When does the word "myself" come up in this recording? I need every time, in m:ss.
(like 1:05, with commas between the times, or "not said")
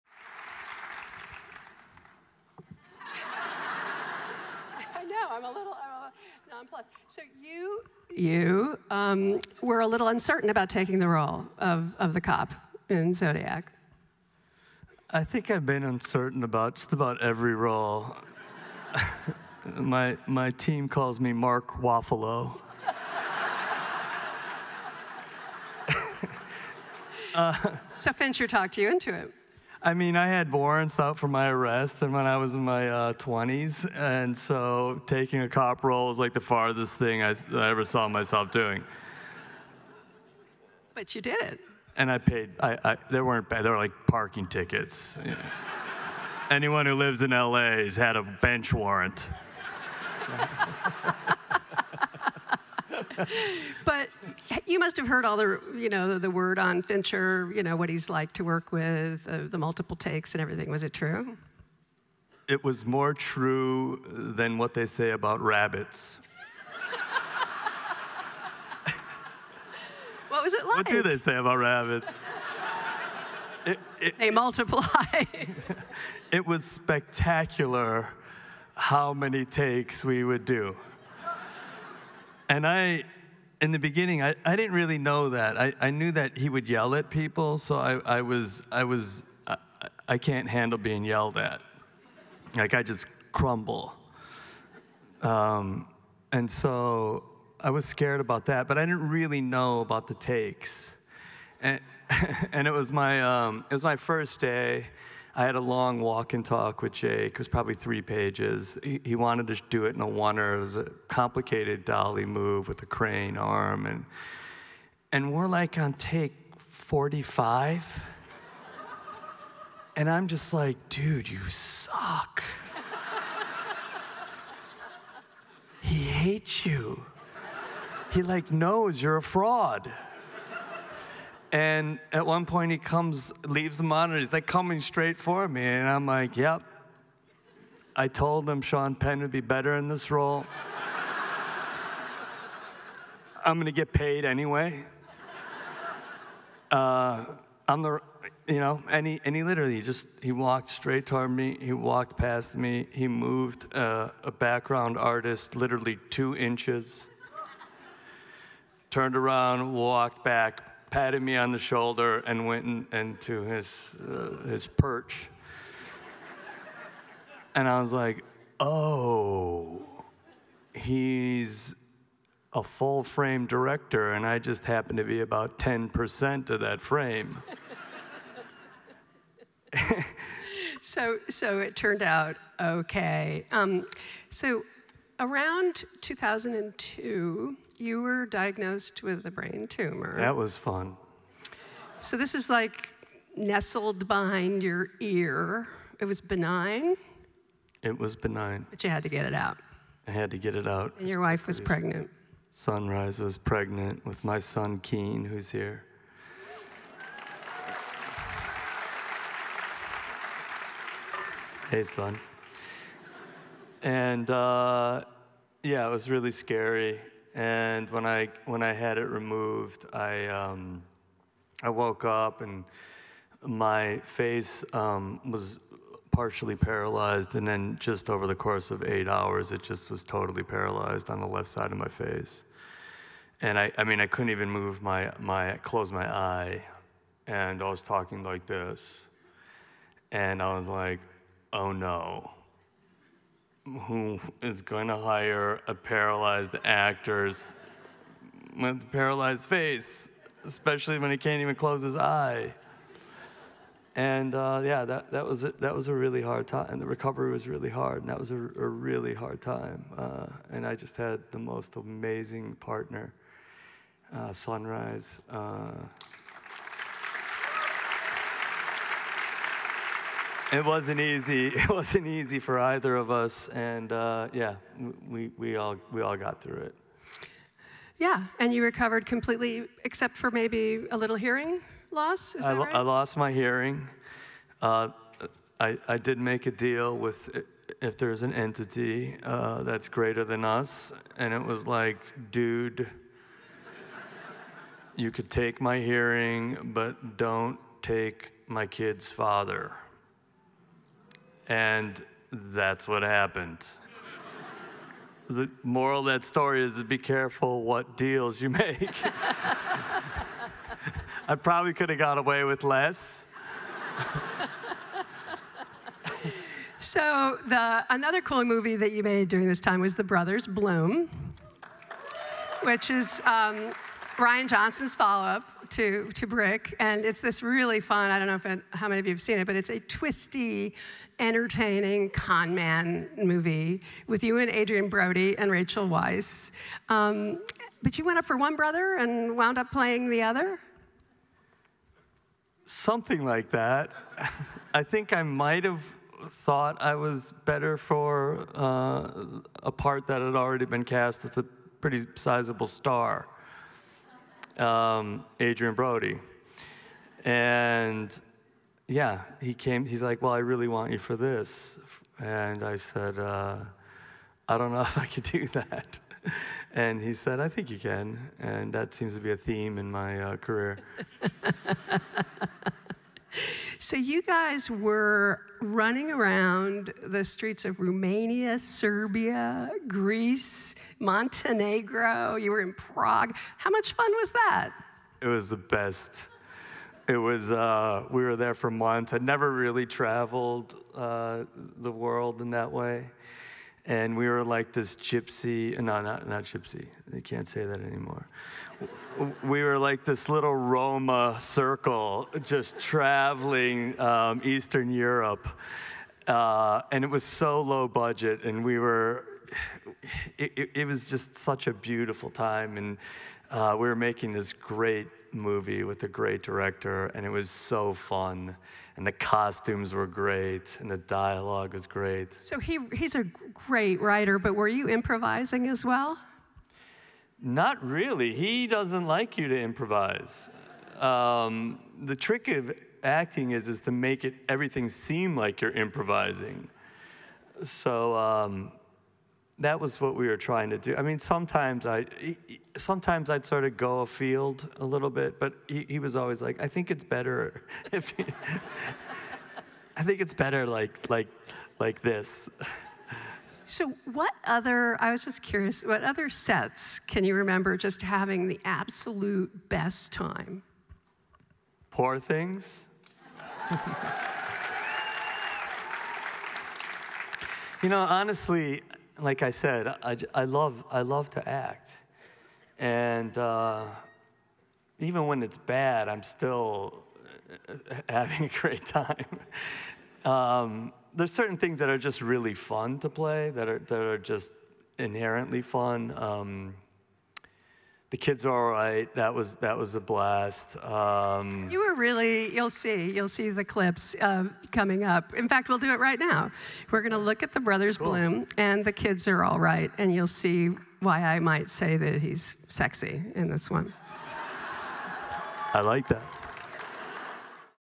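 0:38.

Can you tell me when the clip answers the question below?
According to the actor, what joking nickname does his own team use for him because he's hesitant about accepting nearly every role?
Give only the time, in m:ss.
0:21.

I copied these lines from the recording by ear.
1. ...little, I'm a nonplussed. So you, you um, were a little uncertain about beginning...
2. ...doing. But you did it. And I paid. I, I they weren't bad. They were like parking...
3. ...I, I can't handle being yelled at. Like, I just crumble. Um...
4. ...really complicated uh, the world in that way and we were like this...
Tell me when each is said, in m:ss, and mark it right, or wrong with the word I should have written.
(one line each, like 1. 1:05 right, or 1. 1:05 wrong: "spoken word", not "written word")
1. 0:05 wrong: "taking", not "beginning"
2. 0:38 right
3. 1:29 right
4. 6:29 wrong: "traveled", not "complicated".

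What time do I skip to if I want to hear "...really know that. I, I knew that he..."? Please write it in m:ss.
1:24.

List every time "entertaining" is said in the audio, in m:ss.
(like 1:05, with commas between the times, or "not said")
5:31.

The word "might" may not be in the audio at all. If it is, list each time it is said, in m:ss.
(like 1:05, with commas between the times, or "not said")
5:45, 8:21.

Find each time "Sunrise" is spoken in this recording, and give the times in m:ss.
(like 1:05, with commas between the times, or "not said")
3:22, 4:24.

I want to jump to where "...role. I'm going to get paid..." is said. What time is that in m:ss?
2:20.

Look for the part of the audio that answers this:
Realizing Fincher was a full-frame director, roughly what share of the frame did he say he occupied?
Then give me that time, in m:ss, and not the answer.
2:55.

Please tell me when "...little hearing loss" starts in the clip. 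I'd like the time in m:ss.
4:40.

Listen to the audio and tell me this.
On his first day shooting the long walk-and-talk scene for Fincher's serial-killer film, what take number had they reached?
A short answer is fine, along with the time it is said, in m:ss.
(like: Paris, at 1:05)
45, at 1:56.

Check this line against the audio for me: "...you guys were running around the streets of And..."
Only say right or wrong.
wrong.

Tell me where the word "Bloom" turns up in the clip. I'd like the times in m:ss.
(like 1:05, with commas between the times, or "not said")
5:20, 8:18.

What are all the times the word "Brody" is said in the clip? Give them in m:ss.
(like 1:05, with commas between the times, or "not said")
5:34, 5:55.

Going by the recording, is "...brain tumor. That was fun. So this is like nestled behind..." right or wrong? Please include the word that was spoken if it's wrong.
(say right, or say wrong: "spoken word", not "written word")
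right.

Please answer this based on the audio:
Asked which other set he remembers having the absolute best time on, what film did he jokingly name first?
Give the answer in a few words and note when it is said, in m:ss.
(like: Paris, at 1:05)
Poor Things, at 7:41.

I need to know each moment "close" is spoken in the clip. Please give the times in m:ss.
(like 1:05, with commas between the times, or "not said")
3:55, 4:11.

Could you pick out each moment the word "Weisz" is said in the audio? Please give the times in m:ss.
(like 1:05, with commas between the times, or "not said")
5:35.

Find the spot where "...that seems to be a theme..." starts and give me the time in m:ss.
6:08.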